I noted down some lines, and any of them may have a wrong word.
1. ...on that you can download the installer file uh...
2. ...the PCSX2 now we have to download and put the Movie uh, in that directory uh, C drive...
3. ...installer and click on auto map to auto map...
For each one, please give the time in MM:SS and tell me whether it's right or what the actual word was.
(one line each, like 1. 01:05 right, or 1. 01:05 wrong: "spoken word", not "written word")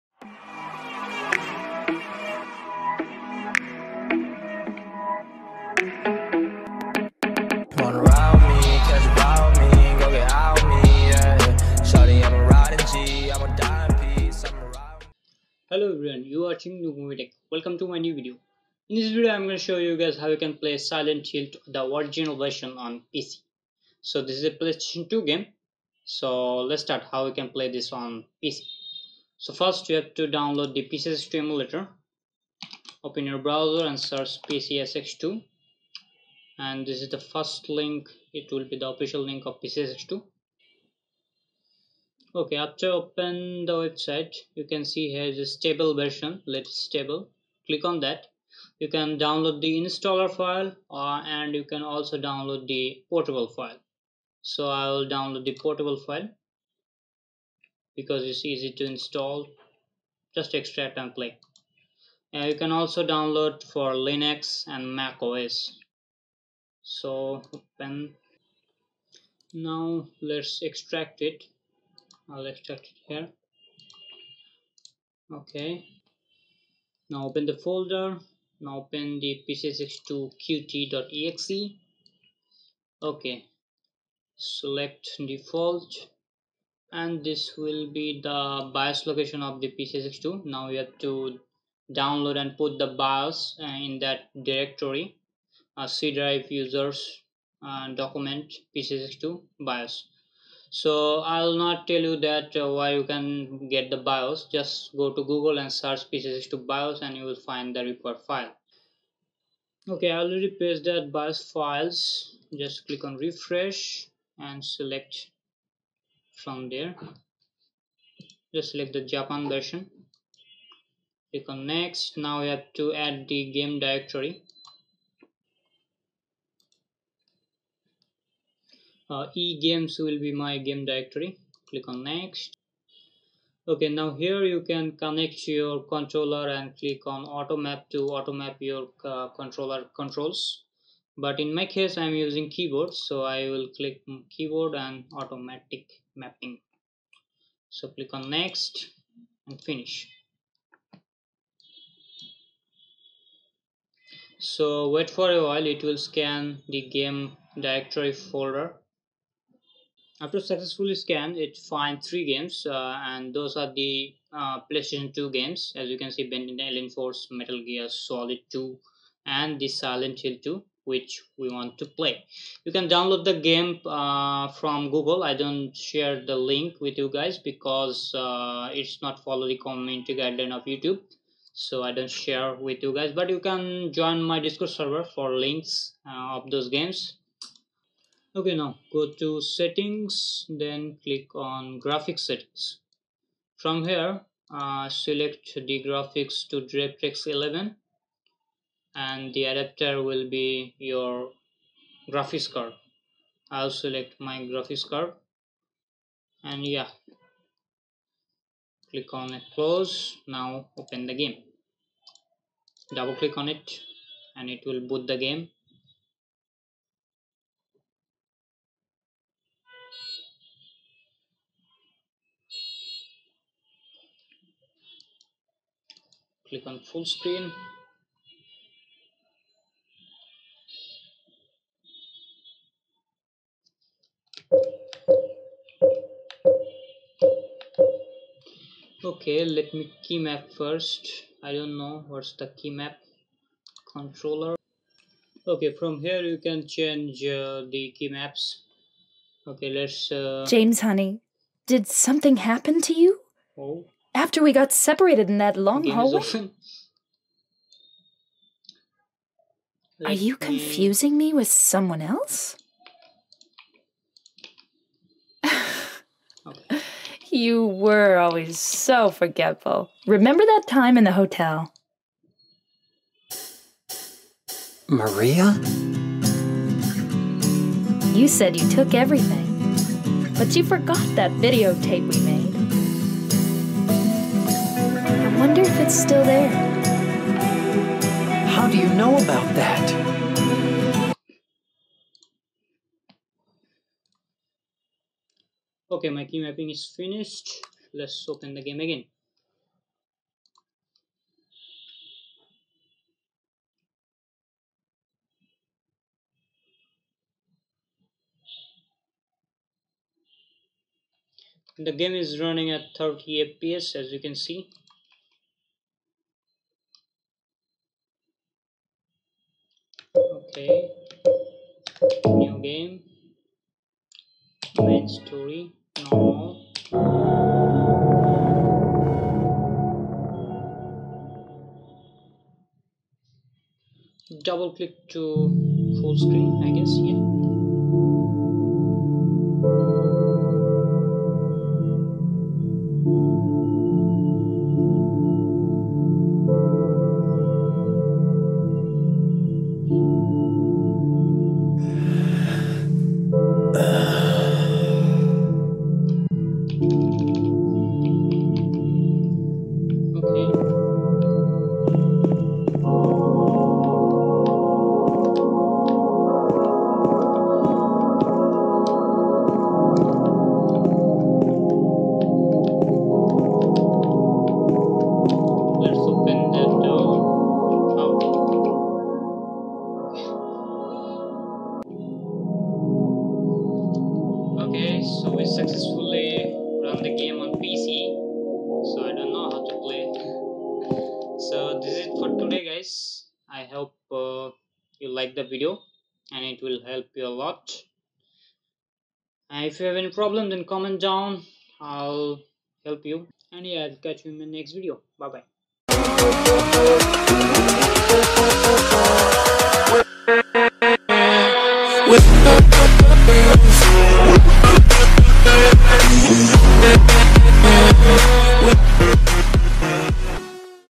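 1. 00:47 right
2. 01:29 wrong: "BIOS", not "Movie"
3. 02:15 wrong: "controller", not "installer".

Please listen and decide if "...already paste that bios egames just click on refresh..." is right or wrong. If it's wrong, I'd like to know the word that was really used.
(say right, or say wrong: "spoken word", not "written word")
wrong: "files", not "egames".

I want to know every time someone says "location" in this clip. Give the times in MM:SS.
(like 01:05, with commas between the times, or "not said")
01:29.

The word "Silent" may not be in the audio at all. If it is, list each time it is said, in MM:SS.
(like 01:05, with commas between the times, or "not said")
00:20, 02:49.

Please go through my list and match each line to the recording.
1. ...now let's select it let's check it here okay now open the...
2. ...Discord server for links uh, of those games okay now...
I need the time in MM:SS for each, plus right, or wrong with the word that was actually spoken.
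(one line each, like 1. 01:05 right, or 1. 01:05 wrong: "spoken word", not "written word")
1. 01:09 wrong: "extract", not "select"
2. 03:04 right.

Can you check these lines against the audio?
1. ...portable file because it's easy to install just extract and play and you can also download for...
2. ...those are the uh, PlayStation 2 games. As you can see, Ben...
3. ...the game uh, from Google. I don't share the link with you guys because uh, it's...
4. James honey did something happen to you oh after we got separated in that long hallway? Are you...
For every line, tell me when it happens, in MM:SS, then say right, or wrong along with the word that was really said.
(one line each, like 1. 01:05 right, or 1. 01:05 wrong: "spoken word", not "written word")
1. 00:55 right
2. 02:43 right
3. 02:53 right
4. 04:10 right.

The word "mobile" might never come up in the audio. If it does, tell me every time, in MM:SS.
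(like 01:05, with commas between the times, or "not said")
not said.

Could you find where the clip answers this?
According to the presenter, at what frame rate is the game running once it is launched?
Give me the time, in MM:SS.
05:12.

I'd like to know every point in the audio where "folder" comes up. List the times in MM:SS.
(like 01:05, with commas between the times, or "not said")
01:17, 02:38.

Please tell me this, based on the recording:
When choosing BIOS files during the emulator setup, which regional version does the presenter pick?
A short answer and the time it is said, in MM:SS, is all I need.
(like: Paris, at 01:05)
Japan, at 01:59.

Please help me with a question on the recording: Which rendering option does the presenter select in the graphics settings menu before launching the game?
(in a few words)
DirectX 11.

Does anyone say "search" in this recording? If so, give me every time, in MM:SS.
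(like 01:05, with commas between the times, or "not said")
00:33, 01:45.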